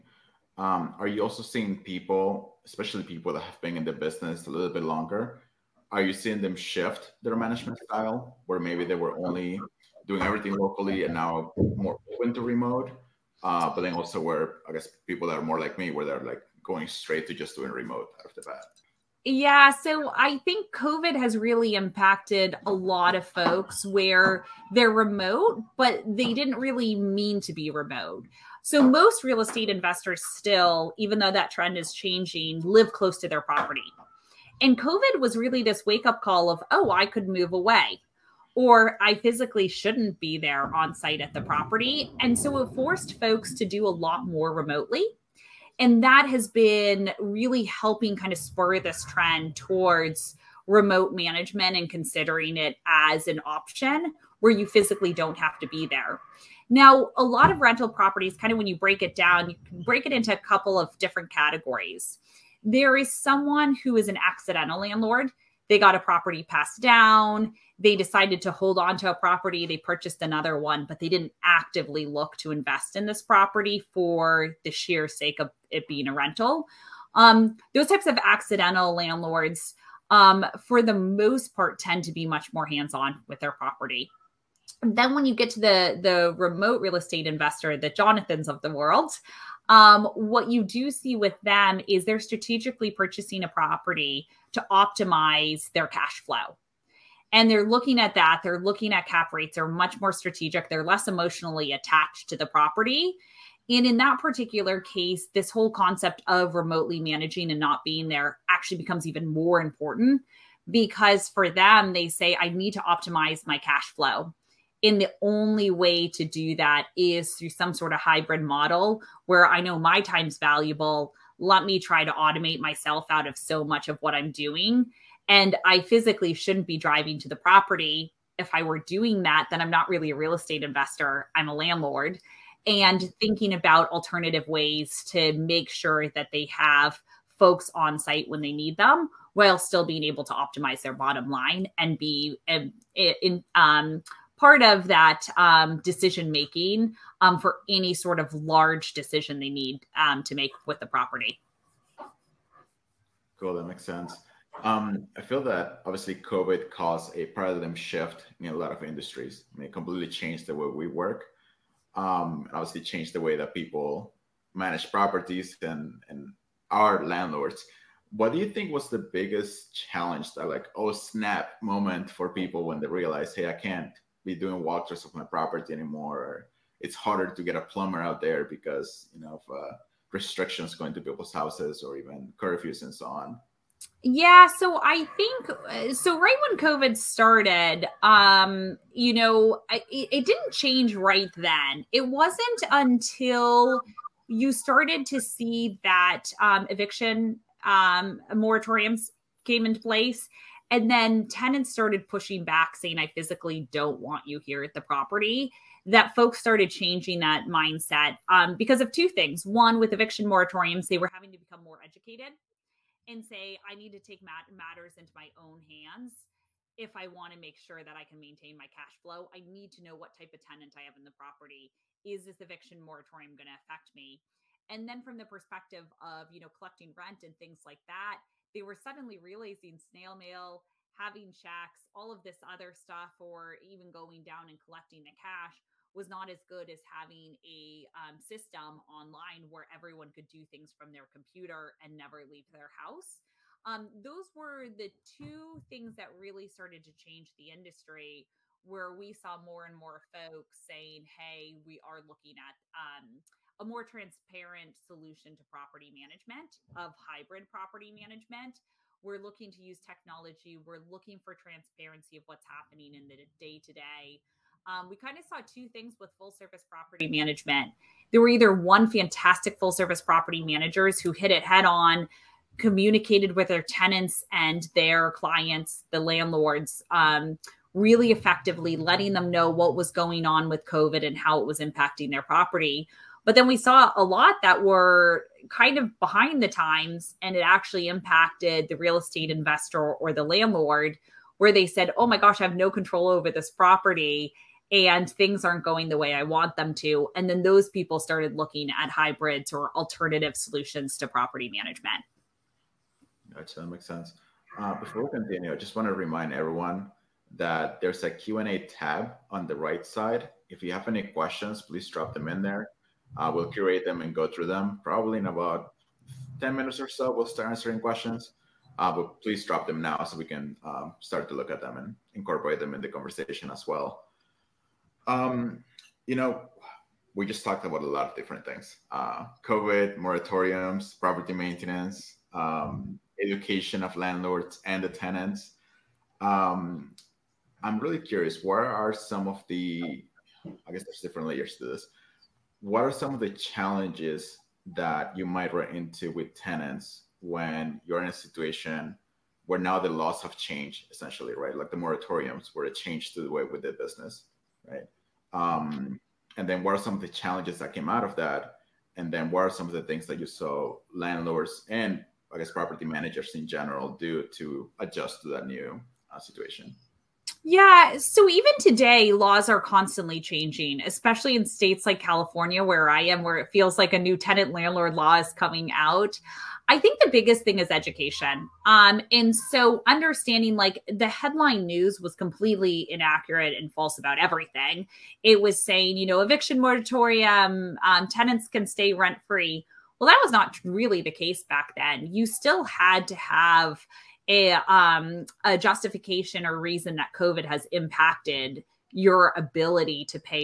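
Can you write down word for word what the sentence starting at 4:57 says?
And then those people started looking at hybrids or alternative solutions to property management.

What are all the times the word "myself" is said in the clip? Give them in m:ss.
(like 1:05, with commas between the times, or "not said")
2:02.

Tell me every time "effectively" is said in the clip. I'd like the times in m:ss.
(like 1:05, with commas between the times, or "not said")
4:38.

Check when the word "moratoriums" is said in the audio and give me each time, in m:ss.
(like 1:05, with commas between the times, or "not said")
3:18, 3:30, 3:42, 5:29, 5:51, 6:26.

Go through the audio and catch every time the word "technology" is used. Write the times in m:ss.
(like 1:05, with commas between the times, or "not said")
4:19.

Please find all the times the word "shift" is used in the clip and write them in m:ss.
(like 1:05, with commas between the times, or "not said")
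0:06, 2:37.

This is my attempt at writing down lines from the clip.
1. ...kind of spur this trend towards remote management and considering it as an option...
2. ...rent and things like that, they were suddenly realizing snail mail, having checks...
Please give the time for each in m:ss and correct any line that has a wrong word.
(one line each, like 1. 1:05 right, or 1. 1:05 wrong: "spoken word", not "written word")
1. 0:48 right
2. 3:46 right.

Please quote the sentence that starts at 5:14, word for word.
Probably in about 10 minutes or so, we'll start answering questions.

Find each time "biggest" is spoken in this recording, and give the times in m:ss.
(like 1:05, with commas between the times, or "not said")
2:49, 6:17.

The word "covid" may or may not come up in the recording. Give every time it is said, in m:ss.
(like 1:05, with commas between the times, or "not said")
0:20, 0:34, 2:36, 3:06, 4:40, 5:29, 6:37.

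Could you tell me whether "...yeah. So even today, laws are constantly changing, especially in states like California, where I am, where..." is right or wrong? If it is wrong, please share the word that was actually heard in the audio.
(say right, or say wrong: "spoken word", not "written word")
right.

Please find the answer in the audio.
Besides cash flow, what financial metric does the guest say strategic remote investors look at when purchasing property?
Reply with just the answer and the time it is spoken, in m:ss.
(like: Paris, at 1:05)
Cap rates, at 1:39.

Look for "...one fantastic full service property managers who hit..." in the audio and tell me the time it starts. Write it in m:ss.
4:28.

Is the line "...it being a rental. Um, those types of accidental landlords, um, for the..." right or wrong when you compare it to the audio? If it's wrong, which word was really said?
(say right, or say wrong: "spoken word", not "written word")
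right.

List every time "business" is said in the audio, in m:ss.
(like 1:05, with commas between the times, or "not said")
0:03, 5:53.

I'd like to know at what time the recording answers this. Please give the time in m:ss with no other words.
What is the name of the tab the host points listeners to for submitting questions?
5:08.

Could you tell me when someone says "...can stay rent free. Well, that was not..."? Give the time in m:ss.
6:28.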